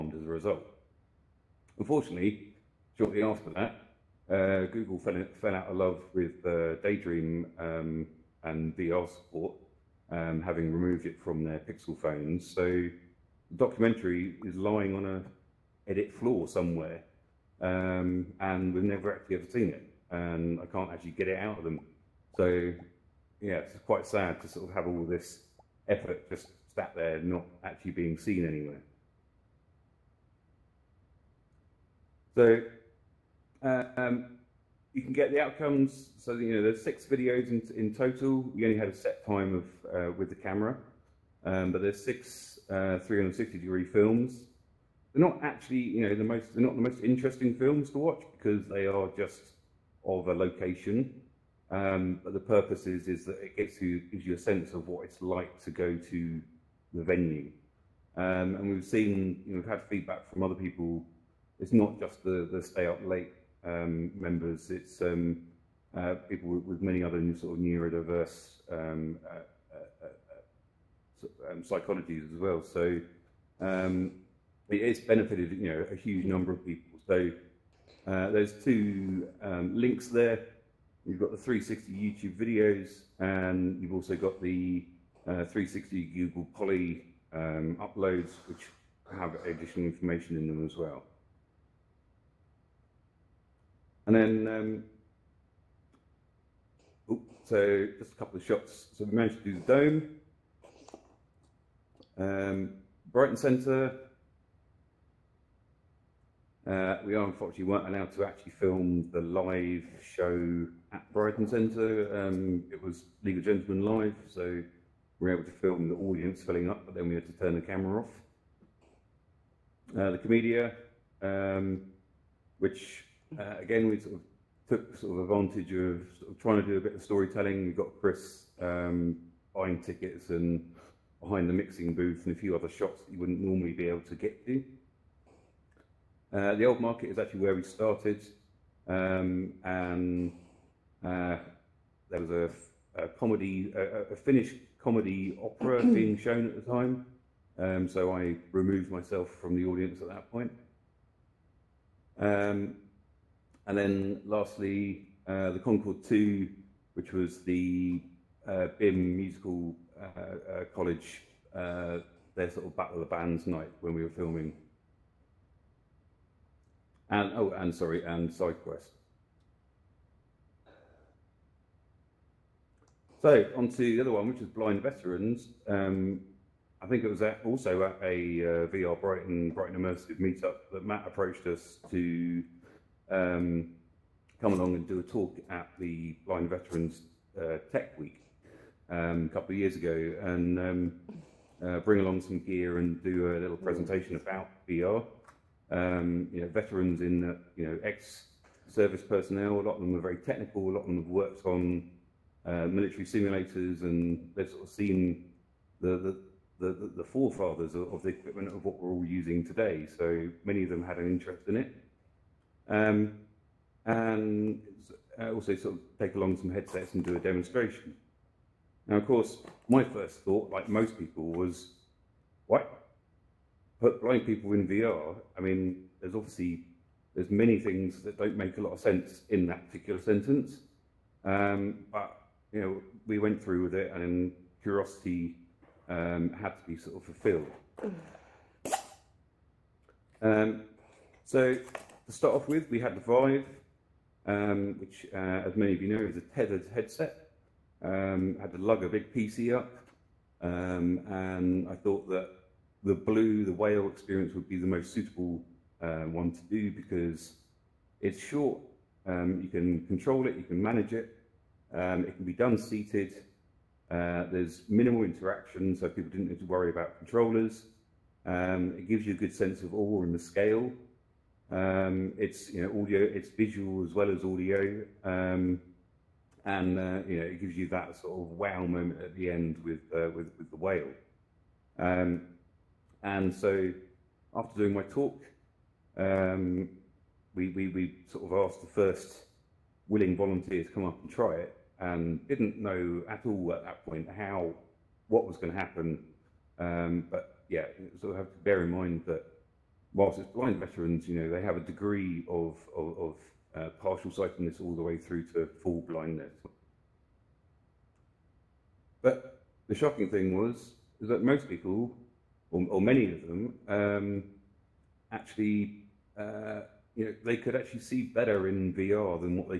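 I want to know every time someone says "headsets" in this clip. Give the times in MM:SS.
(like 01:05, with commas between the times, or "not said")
03:36, 04:06.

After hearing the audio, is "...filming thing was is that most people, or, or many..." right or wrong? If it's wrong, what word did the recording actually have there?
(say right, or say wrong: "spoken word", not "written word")
wrong: "shocking", not "filming".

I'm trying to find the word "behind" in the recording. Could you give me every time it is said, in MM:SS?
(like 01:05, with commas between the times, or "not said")
02:11.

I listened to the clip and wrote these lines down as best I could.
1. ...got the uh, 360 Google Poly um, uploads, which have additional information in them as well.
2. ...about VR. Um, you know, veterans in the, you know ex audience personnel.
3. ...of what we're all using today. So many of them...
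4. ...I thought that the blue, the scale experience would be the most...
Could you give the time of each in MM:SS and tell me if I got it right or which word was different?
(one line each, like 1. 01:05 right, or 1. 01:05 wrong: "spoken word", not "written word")
1. 01:24 right
2. 03:14 wrong: "service", not "audience"
3. 03:28 right
4. 04:11 wrong: "whale", not "scale".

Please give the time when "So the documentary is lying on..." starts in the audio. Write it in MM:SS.
00:12.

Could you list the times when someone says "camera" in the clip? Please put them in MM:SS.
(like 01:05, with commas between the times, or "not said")
00:40, 01:57.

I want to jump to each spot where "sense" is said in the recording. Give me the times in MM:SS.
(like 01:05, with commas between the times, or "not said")
00:54, 03:48, 04:29.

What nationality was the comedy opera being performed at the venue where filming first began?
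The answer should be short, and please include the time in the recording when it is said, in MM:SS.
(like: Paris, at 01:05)
Finnish, at 02:24.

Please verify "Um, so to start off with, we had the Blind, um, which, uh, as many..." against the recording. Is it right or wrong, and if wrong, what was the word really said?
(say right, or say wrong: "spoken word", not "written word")
wrong: "Vive", not "Blind".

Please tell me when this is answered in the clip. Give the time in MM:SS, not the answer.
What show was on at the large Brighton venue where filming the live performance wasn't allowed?
01:53.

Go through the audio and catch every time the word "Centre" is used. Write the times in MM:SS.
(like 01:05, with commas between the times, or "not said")
01:43, 01:51.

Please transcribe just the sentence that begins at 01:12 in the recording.
So it's benefited, you know, a huge number of people.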